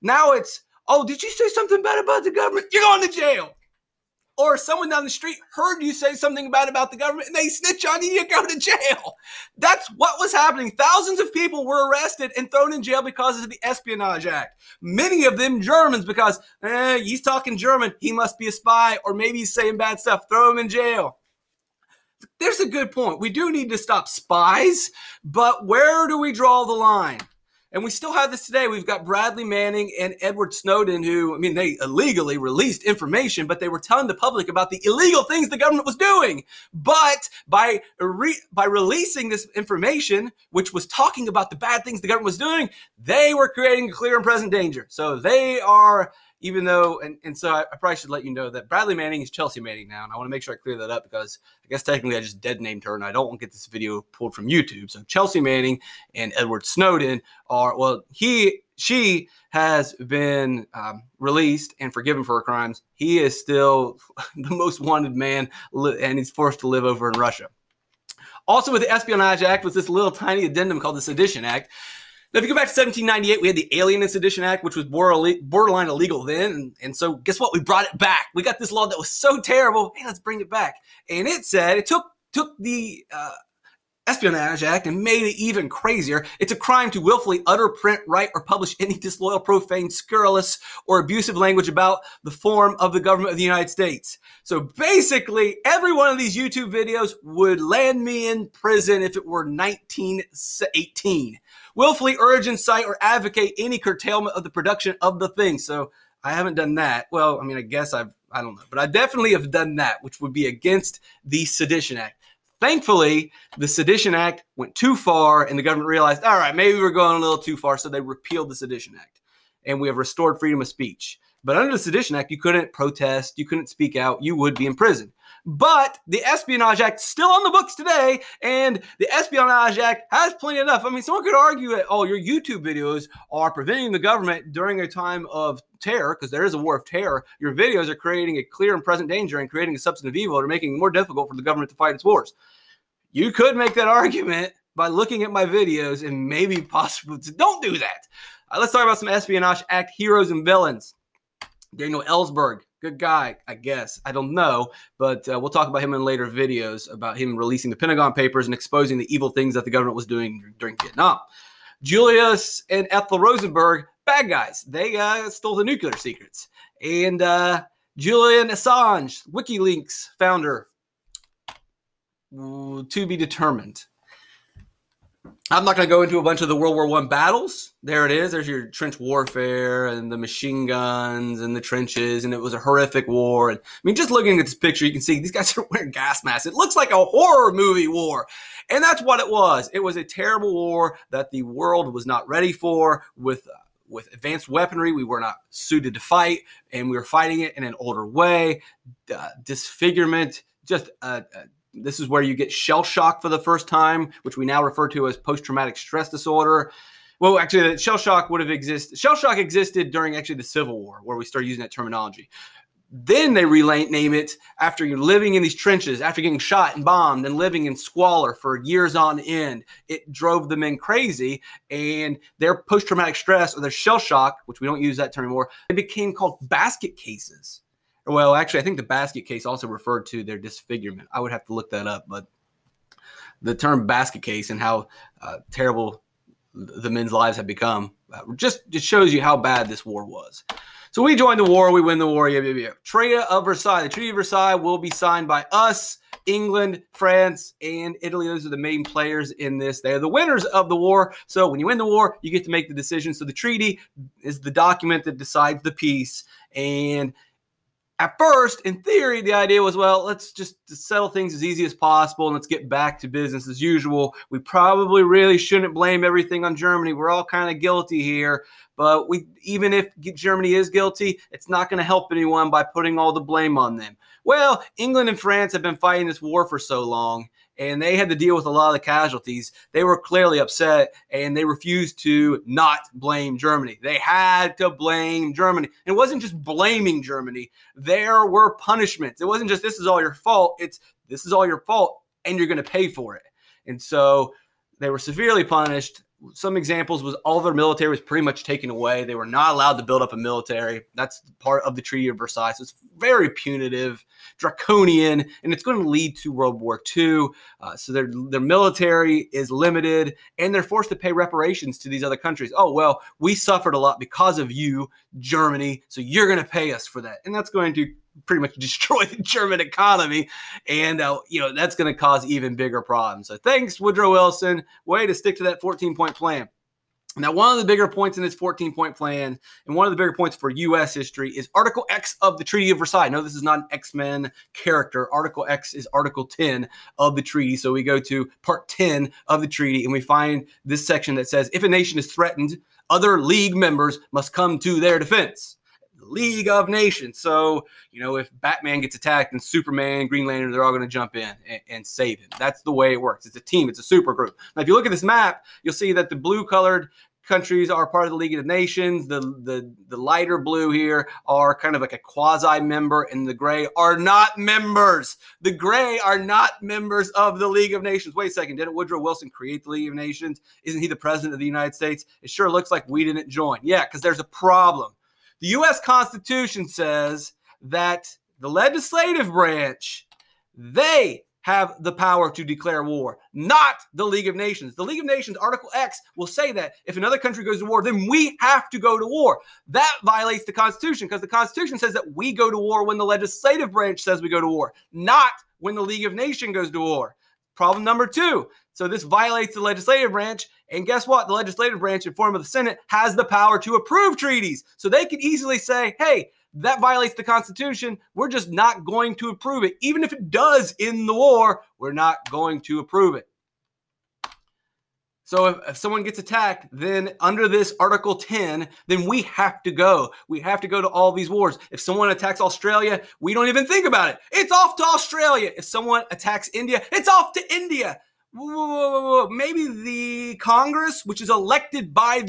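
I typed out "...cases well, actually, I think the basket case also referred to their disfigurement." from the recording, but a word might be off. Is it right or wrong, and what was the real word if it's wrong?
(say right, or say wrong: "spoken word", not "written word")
right.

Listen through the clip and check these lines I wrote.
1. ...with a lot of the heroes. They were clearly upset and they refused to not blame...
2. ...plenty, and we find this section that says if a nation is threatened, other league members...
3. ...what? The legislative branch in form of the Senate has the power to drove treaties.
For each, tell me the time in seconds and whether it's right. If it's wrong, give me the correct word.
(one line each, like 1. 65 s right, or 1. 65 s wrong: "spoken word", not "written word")
1. 278 s wrong: "casualties", not "heroes"
2. 339 s wrong: "treaty", not "plenty"
3. 401 s wrong: "approve", not "drove".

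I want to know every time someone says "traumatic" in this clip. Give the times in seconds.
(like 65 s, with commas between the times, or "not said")
205 s, 222 s.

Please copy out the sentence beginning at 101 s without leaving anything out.
Willfully urge, incite, or advocate any curtailment of the production of the thing.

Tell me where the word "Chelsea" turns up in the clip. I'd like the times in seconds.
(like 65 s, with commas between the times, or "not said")
49 s, 55 s.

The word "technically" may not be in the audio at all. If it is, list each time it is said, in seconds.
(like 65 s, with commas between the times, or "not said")
51 s.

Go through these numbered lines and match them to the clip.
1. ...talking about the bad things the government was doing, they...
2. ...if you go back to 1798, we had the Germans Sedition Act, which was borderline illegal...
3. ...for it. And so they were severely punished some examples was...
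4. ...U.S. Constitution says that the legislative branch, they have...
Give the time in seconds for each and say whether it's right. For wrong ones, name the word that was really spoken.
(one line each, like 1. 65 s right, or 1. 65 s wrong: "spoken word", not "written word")
1. 40 s right
2. 72 s wrong: "Alien", not "Germans"
3. 292 s right
4. 375 s right.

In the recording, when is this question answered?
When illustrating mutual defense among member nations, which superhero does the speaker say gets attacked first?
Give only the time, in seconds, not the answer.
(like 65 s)
348 s.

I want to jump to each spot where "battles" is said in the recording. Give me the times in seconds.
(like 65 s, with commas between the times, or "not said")
177 s.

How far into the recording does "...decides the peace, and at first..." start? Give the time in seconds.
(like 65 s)
255 s.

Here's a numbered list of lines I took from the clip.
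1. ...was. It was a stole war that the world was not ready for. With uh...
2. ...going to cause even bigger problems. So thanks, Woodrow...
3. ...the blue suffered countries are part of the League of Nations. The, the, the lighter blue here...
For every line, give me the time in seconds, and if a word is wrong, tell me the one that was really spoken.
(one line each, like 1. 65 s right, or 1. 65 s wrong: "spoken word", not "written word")
1. 189 s wrong: "terrible", not "stole"
2. 321 s right
3. 356 s wrong: "colored", not "suffered".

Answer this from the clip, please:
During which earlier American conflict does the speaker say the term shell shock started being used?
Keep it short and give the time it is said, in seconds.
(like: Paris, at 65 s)
Civil War, at 210 s.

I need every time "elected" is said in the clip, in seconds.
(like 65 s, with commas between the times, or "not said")
431 s.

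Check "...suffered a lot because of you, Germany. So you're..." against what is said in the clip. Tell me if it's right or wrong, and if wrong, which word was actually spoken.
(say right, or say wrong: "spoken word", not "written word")
right.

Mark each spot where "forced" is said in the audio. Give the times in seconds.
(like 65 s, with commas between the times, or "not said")
66 s, 310 s.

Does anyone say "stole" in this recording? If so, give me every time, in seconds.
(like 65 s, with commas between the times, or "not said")
165 s.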